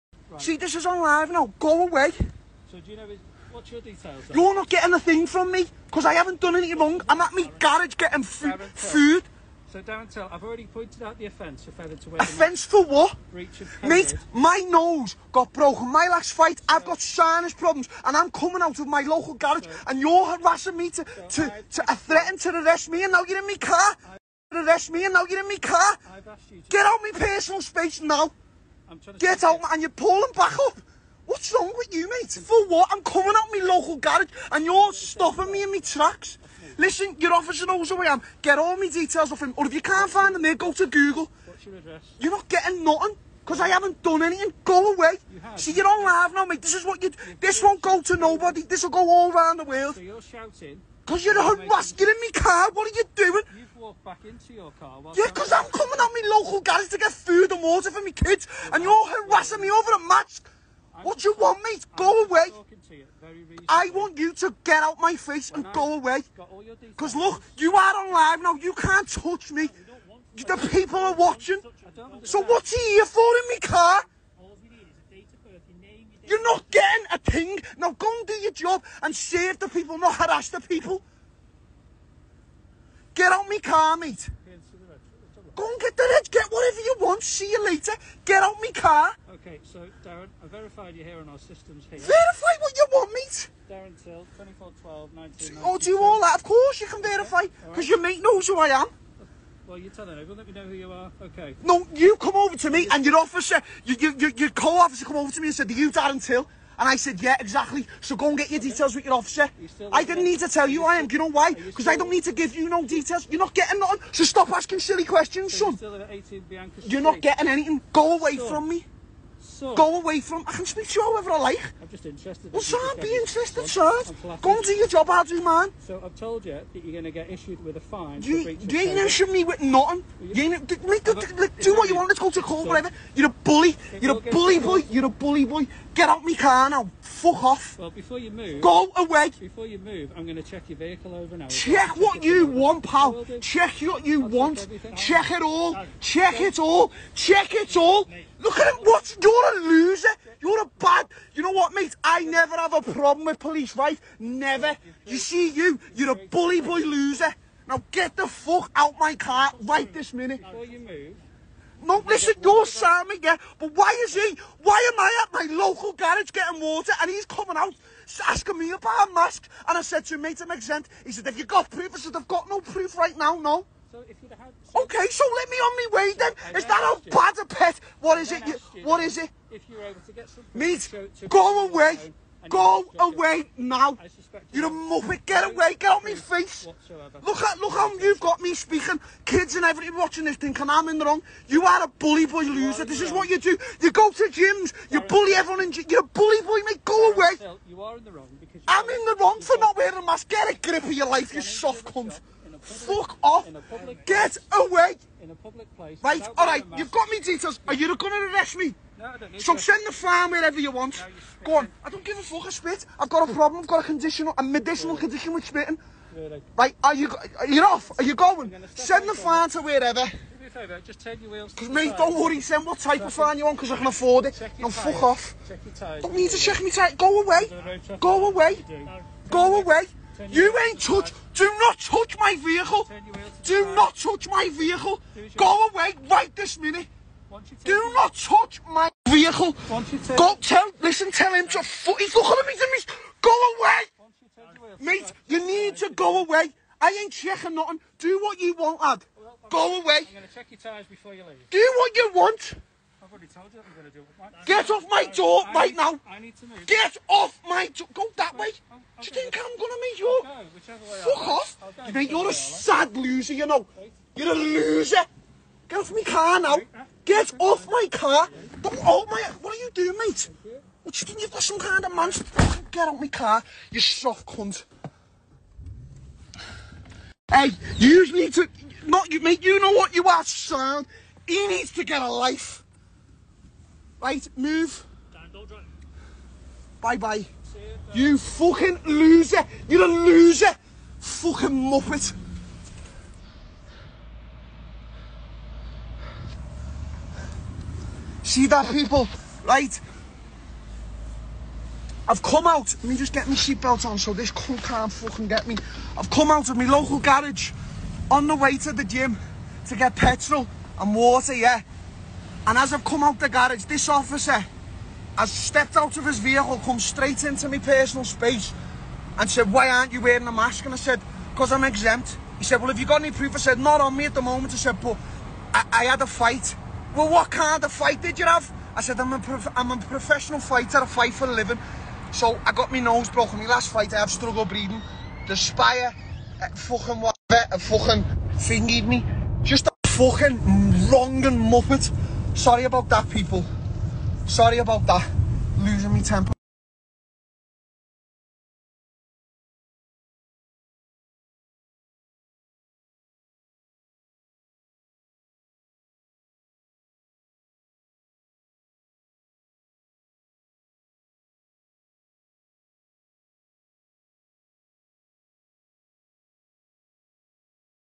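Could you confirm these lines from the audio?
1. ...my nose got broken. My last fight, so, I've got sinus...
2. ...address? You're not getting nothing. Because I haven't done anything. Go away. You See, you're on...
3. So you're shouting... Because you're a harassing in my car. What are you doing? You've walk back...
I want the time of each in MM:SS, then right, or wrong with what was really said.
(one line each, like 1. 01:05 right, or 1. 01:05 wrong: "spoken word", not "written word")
1. 00:14 right
2. 00:41 right
3. 00:49 right.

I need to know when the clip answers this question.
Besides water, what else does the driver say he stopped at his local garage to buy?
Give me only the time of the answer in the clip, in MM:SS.
05:09.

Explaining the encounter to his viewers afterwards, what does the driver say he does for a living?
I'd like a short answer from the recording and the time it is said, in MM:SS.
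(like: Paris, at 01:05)
professional fighter, at 05:29.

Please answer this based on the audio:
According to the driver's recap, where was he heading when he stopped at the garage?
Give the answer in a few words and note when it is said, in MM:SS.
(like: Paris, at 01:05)
the gym, at 05:08.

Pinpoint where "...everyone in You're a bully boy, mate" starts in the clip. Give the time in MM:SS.
03:15.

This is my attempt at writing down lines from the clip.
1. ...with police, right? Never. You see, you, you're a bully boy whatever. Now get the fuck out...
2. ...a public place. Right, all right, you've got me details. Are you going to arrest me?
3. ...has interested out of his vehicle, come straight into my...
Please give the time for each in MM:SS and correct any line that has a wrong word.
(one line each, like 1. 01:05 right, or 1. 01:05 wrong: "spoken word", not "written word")
1. 02:33 wrong: "loser", not "whatever"
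2. 03:25 right
3. 05:15 wrong: "stepped", not "interested".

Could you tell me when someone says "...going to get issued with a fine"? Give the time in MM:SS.
02:06.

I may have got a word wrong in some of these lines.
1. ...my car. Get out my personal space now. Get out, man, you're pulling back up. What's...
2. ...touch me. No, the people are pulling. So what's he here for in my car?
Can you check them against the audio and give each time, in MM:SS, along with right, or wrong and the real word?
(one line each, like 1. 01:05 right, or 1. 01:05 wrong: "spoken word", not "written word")
1. 00:25 right
2. 01:09 wrong: "watching", not "pulling".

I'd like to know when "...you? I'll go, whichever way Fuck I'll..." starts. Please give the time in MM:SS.
04:19.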